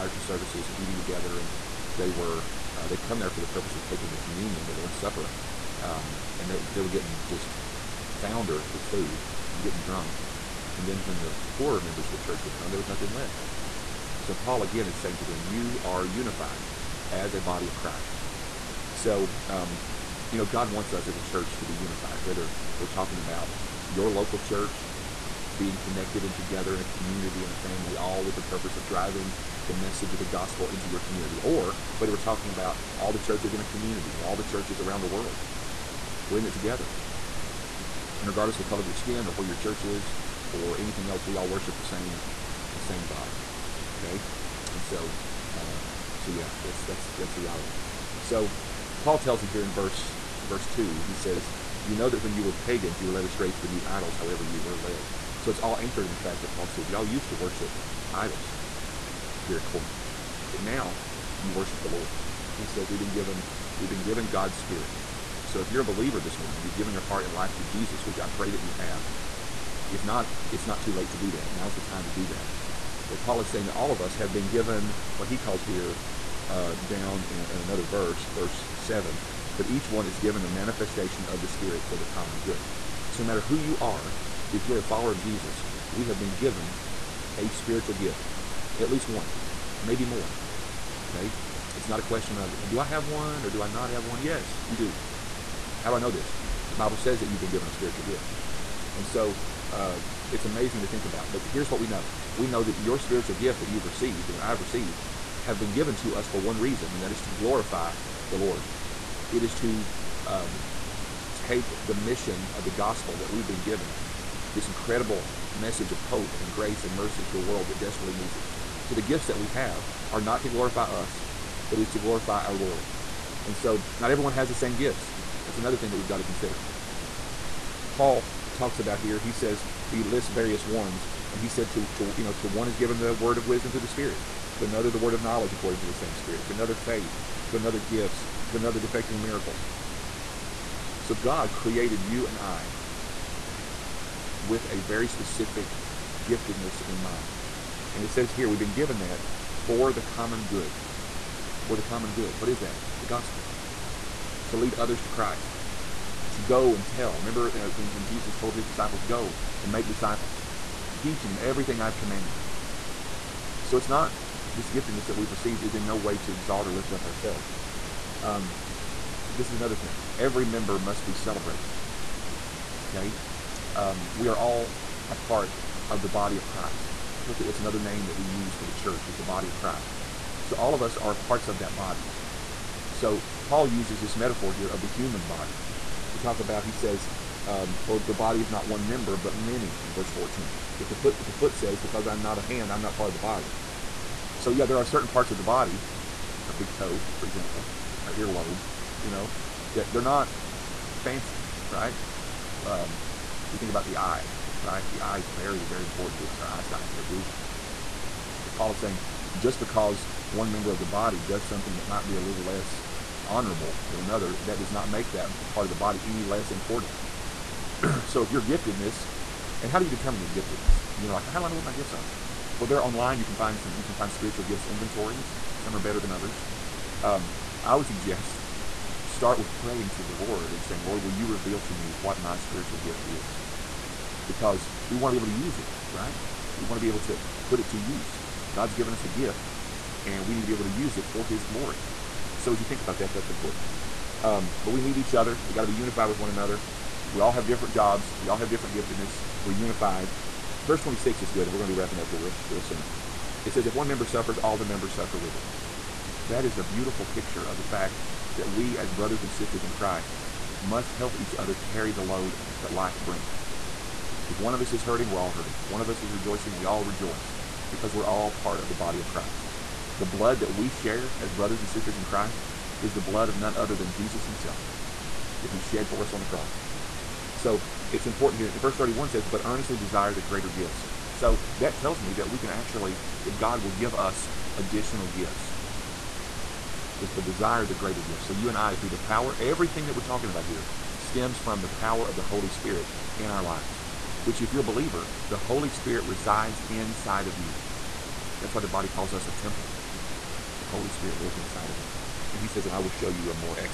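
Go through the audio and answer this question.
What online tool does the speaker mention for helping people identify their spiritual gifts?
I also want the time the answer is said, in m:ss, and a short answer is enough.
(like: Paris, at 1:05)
spiritual gifts inventories, at 3:44.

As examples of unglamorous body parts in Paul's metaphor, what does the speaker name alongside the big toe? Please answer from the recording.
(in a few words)
earlobe.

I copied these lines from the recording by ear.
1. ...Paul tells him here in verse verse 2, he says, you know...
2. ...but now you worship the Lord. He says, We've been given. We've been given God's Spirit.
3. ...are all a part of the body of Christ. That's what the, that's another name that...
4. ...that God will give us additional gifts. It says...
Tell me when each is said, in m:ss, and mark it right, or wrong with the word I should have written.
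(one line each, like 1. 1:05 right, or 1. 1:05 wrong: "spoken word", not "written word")
1. 0:48 right
2. 1:00 right
3. 2:54 right
4. 4:43 right.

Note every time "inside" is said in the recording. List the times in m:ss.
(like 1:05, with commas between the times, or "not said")
4:56, 5:01.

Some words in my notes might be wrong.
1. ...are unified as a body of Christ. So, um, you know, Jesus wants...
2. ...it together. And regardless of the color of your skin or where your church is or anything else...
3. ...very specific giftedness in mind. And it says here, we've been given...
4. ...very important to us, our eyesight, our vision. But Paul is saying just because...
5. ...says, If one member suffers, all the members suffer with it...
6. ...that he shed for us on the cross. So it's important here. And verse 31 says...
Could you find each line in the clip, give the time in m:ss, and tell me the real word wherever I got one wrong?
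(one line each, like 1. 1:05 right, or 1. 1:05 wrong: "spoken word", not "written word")
1. 0:15 wrong: "God", not "Jesus"
2. 0:36 right
3. 2:24 right
4. 3:25 right
5. 4:13 right
6. 4:35 right.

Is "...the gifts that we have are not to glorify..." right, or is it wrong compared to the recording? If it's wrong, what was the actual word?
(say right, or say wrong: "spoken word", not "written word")
right.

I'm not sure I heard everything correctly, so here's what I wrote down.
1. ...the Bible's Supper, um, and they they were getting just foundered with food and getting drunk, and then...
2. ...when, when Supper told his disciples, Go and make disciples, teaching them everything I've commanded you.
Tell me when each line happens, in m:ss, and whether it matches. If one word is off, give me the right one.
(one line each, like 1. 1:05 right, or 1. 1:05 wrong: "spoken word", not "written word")
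1. 0:04 wrong: "Lord", not "Bible"
2. 2:37 wrong: "Jesus", not "Supper".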